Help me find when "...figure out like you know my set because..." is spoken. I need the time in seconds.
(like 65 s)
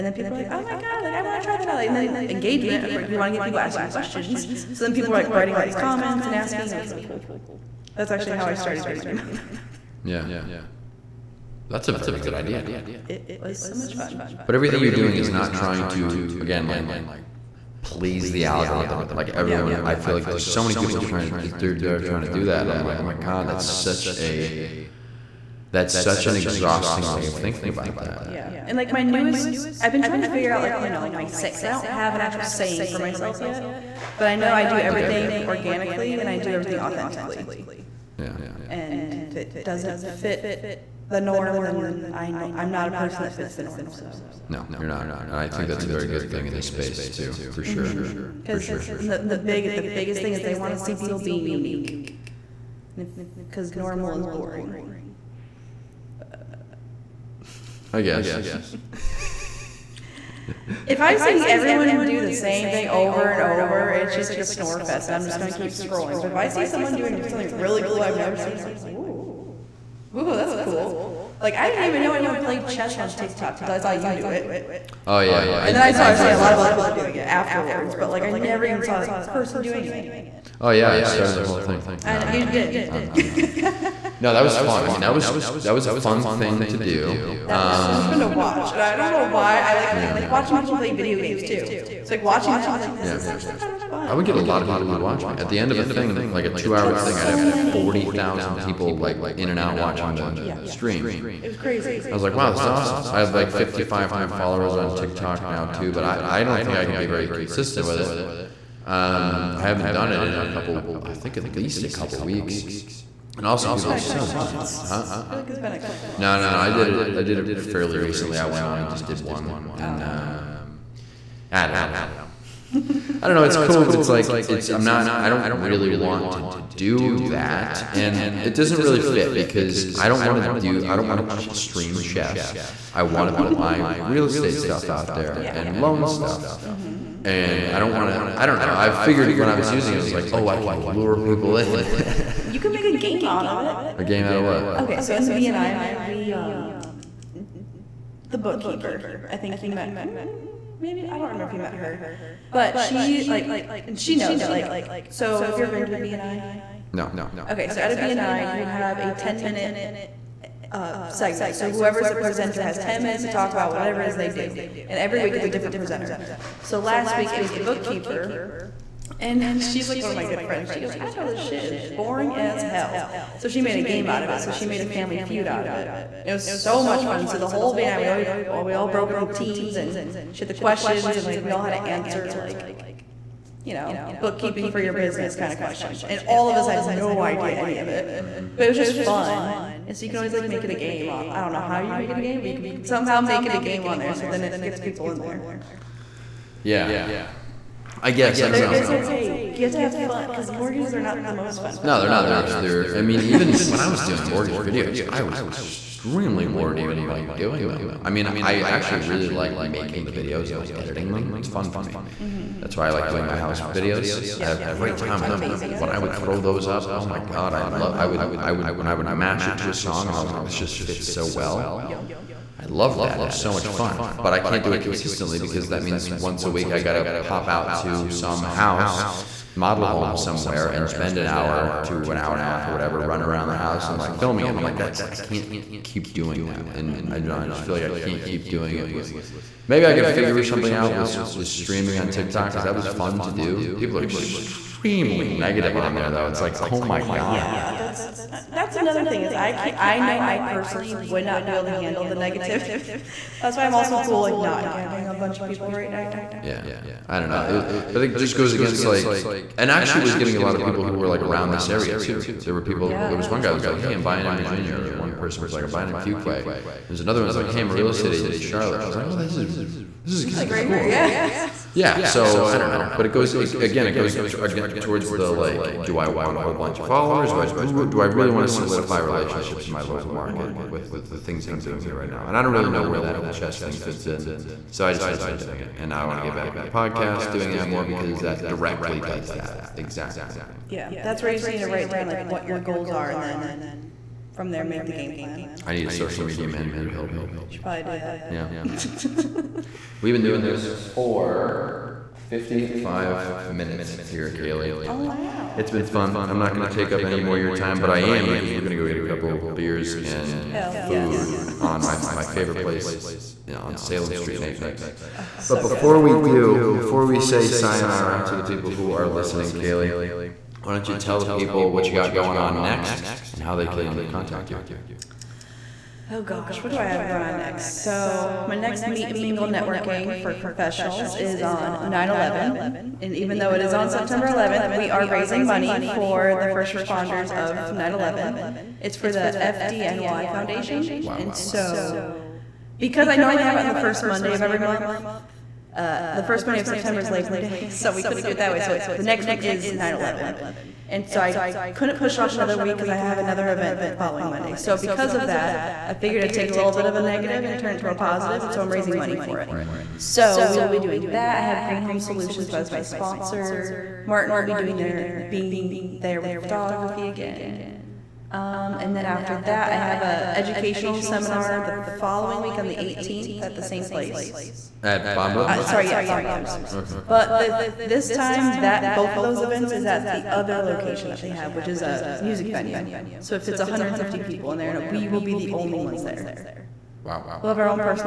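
30 s.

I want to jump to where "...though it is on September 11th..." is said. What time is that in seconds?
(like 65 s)
333 s.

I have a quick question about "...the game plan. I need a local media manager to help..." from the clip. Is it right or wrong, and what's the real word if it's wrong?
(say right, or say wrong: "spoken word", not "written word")
wrong: "social", not "local".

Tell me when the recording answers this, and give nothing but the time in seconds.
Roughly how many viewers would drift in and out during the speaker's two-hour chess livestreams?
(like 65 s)
97 s.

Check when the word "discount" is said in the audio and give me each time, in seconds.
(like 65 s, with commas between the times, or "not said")
not said.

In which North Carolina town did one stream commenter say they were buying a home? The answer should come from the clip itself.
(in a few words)
Fuquay.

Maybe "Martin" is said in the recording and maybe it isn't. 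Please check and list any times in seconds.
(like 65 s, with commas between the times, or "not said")
364 s.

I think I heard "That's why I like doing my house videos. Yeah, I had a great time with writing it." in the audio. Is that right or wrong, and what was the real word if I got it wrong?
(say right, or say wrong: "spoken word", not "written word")
wrong: "amazing", not "writing".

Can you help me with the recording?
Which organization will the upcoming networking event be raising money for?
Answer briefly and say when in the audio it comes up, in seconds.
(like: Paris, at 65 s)
FDNY Foundation, at 339 s.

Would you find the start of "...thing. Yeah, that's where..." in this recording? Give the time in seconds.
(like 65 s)
290 s.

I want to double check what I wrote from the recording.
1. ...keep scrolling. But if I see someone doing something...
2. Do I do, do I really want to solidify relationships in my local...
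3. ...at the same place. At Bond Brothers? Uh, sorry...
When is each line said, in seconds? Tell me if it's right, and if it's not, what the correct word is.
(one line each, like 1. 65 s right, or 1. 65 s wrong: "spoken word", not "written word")
1. 65 s right
2. 277 s right
3. 373 s right.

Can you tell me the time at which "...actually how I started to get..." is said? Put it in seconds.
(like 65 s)
8 s.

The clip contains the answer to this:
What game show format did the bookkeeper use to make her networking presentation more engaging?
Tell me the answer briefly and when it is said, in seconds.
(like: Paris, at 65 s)
Family Feud, at 174 s.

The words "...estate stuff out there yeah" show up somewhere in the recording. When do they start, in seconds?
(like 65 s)
134 s.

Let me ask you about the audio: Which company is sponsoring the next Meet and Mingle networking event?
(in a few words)
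Green Home Solutions.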